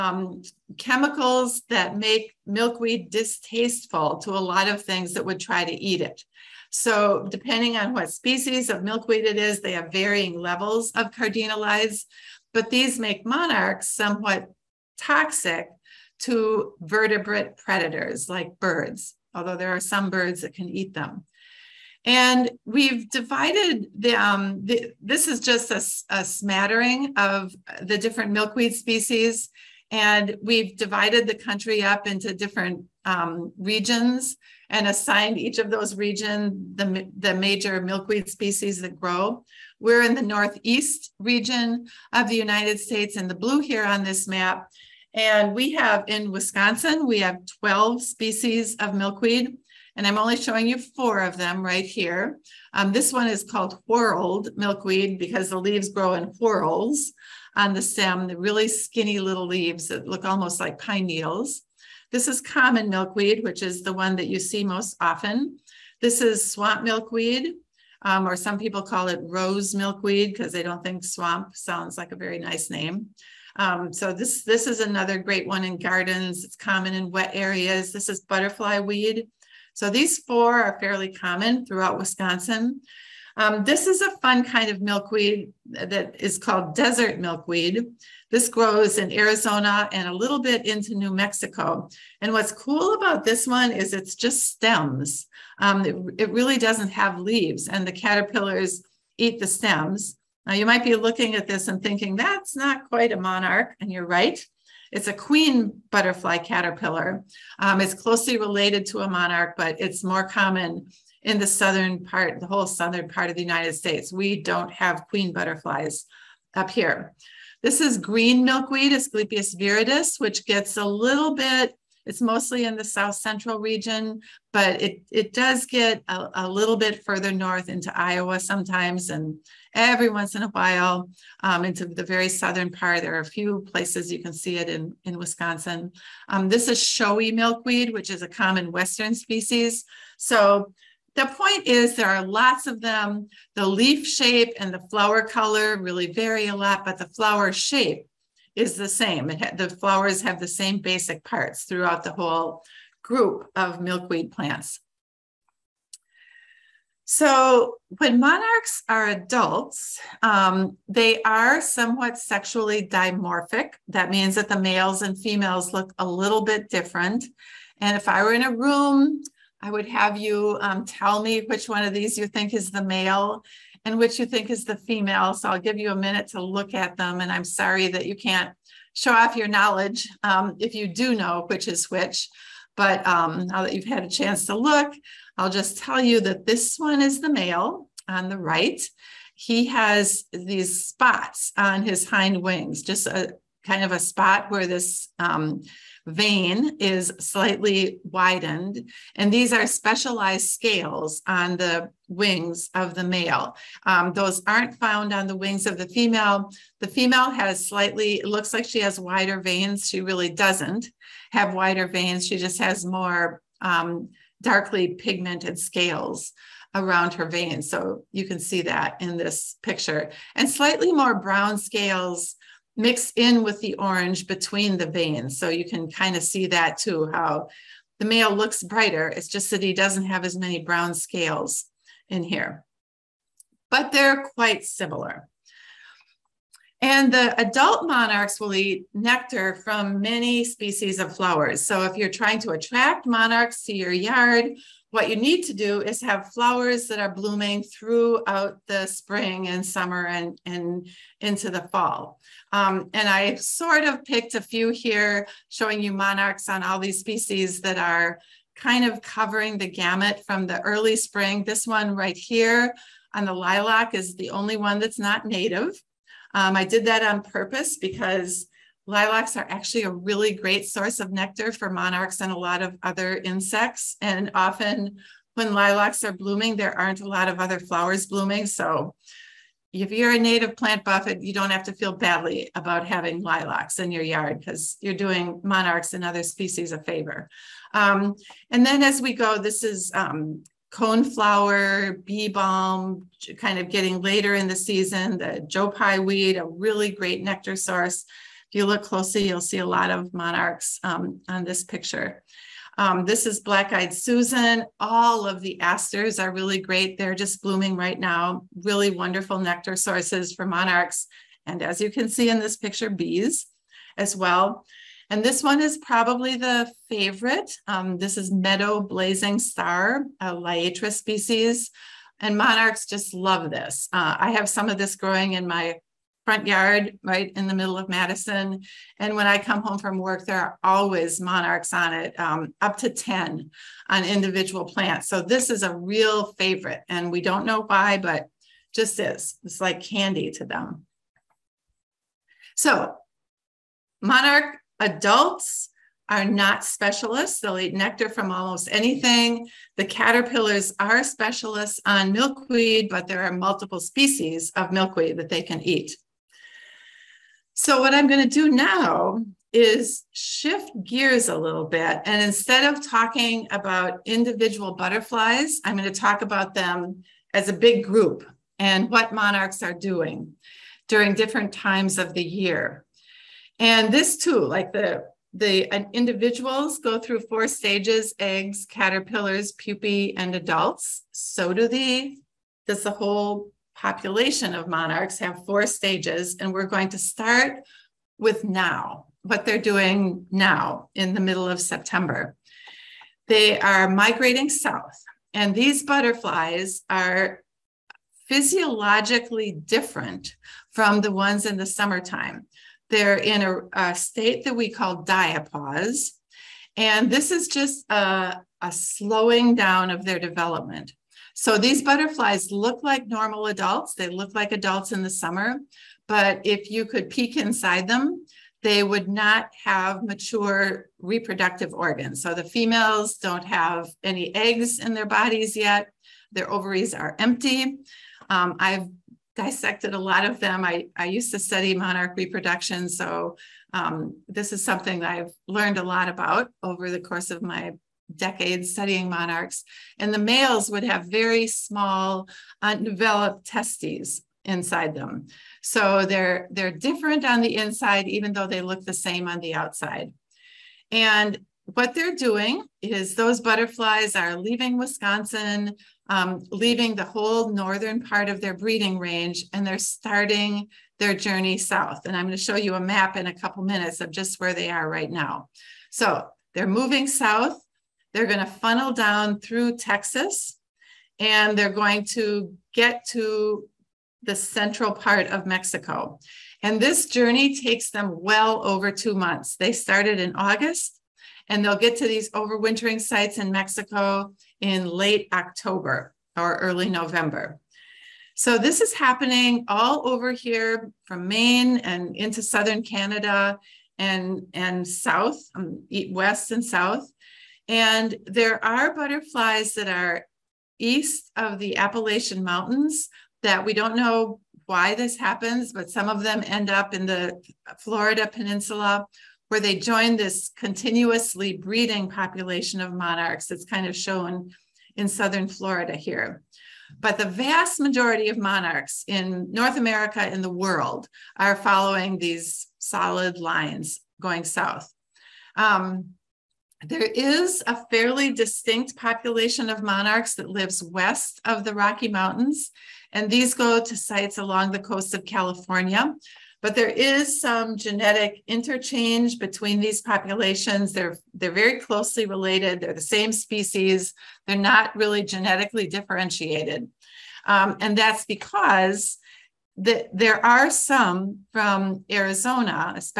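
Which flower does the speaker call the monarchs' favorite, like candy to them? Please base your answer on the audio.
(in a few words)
Meadow blazing star.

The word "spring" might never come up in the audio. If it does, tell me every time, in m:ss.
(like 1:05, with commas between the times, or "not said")
4:08, 4:20.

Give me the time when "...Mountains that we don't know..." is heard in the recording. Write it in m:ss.
8:22.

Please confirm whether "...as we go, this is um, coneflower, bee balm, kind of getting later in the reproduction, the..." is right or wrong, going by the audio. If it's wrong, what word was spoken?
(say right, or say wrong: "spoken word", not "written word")
wrong: "season", not "reproduction".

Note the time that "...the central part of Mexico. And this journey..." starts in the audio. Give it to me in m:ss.
7:54.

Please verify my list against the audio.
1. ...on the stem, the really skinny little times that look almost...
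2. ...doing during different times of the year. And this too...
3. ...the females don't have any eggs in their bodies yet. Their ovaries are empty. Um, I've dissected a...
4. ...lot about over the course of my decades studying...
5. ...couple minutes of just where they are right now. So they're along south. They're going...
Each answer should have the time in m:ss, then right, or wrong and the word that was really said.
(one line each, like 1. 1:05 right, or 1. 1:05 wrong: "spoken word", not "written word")
1. 0:57 wrong: "leaves", not "times"
2. 6:09 right
3. 7:02 right
4. 7:15 right
5. 7:43 wrong: "moving", not "along".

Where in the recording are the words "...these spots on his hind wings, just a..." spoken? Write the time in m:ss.
3:10.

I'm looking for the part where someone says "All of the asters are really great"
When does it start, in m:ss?
5:04.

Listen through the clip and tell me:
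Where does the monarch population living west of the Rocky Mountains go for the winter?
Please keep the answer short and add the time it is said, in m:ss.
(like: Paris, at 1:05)
Coast of California, at 8:54.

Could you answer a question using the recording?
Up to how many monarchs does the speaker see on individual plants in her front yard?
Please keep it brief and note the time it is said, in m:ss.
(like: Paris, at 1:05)
10, at 5:32.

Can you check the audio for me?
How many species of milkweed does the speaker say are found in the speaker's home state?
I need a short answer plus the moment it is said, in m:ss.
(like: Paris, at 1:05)
12, at 0:47.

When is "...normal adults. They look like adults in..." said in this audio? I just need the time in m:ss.
6:53.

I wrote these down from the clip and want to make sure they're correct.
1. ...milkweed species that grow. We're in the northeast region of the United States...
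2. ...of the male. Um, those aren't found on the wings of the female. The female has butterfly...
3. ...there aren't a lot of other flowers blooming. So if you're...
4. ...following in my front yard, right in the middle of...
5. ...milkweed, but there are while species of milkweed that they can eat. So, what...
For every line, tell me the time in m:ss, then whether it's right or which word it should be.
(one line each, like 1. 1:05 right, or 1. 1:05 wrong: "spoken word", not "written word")
1. 0:37 right
2. 3:22 wrong: "slightly", not "butterfly"
3. 4:36 right
4. 5:24 wrong: "growing", not "following"
5. 5:52 wrong: "multiple", not "while".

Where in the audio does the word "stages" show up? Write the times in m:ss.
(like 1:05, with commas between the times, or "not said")
6:17, 6:25.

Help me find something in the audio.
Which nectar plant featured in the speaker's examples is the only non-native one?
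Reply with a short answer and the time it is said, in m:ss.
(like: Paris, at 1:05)
Lilac, at 4:23.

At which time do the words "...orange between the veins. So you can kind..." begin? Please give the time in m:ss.
3:43.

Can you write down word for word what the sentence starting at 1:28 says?
This grows in Arizona and a little bit into New Mexico.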